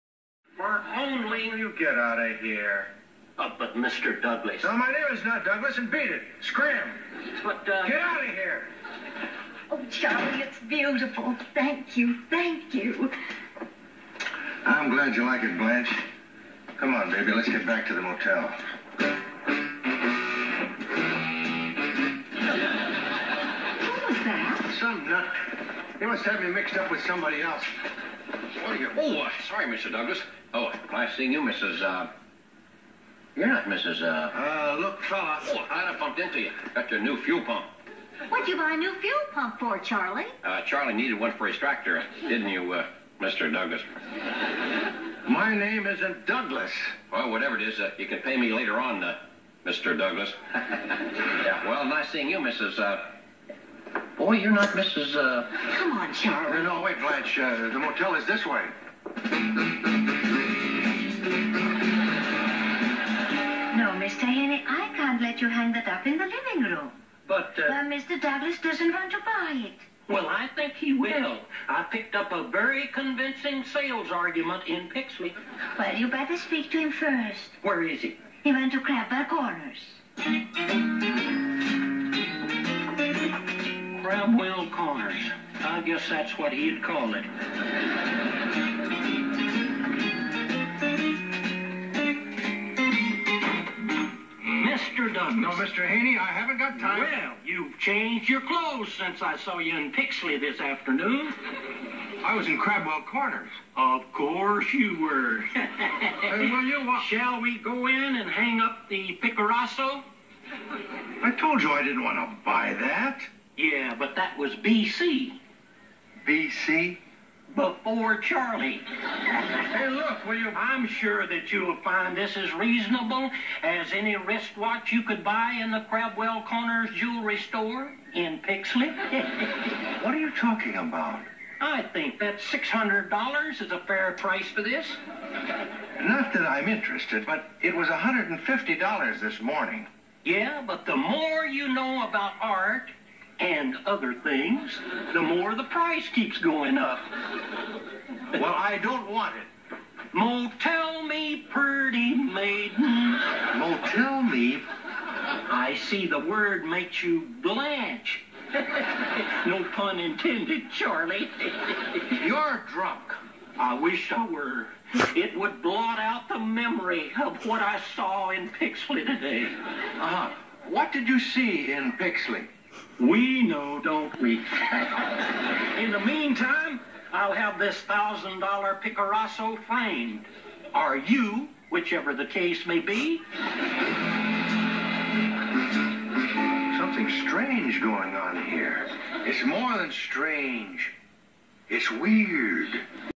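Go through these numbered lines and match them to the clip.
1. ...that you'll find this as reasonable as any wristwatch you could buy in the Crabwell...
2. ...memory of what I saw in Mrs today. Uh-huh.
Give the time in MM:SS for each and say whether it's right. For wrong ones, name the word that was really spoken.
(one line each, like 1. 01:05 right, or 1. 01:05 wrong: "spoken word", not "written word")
1. 02:01 right
2. 02:46 wrong: "Pixley", not "Mrs".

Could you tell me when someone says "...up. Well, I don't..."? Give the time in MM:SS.
02:26.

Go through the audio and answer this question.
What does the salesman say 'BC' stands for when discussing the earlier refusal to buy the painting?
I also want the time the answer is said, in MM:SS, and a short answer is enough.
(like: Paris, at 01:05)
Before Charlie, at 01:57.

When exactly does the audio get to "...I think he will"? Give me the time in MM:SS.
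01:10.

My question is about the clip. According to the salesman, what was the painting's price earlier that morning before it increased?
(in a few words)
$150.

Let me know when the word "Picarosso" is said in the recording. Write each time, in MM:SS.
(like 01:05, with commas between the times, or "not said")
01:49, 02:58.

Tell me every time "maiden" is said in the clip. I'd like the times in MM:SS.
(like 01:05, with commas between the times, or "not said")
02:32.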